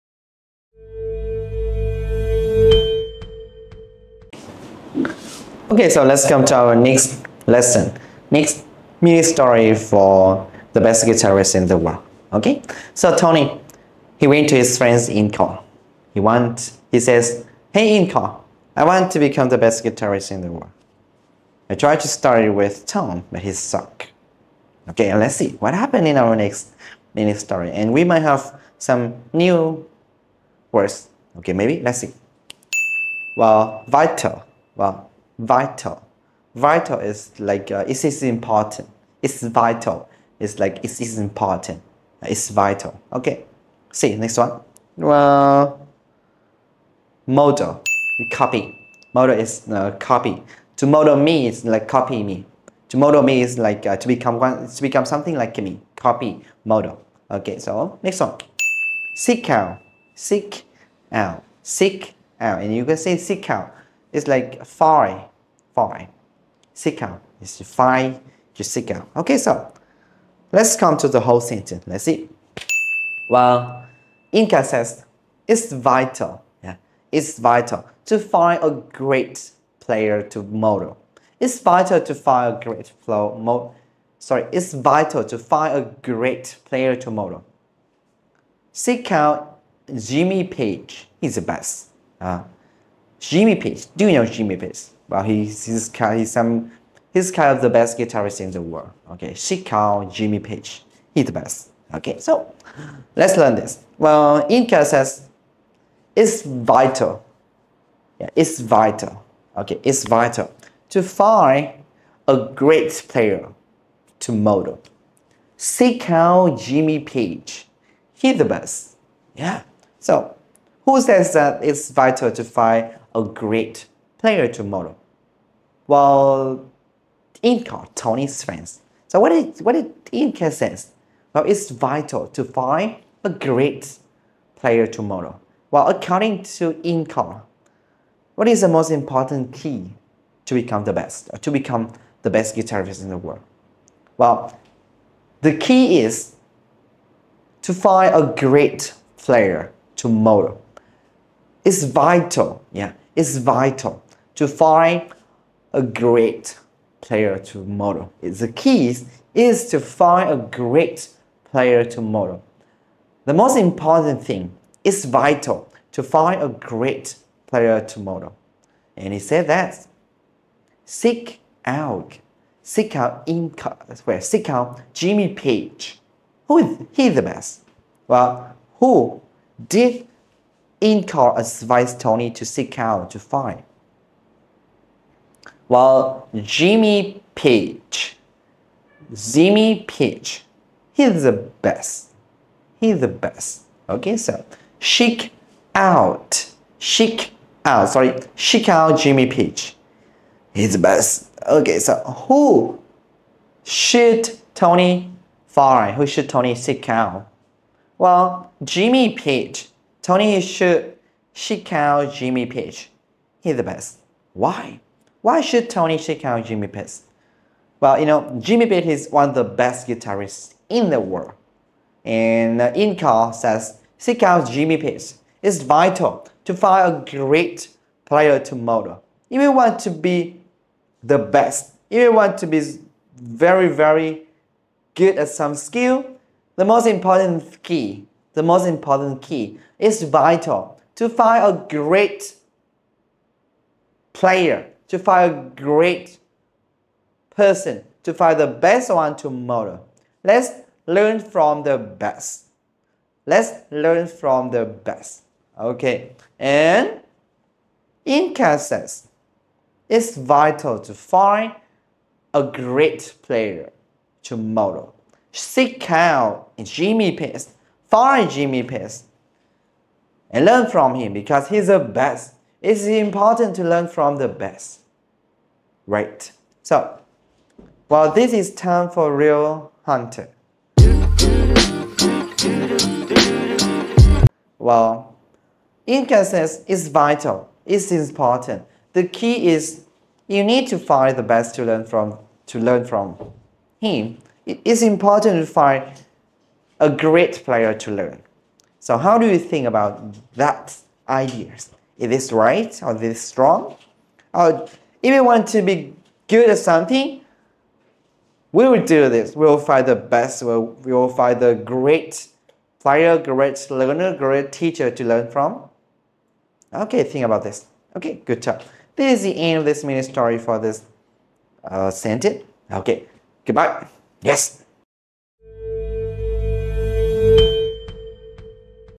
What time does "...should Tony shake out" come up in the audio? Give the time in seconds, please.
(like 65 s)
206 s.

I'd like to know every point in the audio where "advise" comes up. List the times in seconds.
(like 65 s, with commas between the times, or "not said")
181 s.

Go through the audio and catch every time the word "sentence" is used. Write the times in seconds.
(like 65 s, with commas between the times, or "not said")
71 s, 321 s.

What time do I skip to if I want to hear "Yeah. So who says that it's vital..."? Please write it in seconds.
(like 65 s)
119 s.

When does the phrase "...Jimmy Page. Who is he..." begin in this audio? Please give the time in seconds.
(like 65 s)
174 s.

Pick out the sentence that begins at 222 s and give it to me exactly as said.
And uh, says, seek out Jimmy Page.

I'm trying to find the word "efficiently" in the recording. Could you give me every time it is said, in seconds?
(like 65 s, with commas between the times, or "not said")
not said.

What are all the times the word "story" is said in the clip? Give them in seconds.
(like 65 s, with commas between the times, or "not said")
9 s, 27 s, 320 s.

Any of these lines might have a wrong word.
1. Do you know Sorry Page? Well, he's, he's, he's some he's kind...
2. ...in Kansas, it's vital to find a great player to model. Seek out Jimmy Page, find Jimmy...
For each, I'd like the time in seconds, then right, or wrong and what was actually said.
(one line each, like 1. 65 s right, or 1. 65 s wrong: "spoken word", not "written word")
1. 93 s wrong: "Jimmy", not "Sorry"
2. 258 s right.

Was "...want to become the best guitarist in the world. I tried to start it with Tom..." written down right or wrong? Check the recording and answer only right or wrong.
right.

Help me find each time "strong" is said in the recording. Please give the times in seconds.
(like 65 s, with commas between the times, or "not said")
303 s.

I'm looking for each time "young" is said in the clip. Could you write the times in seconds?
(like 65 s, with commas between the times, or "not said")
not said.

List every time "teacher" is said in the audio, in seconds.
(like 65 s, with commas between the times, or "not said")
314 s.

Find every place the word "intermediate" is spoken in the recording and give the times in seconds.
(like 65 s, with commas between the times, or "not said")
not said.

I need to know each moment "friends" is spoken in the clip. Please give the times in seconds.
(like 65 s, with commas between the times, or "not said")
14 s, 128 s.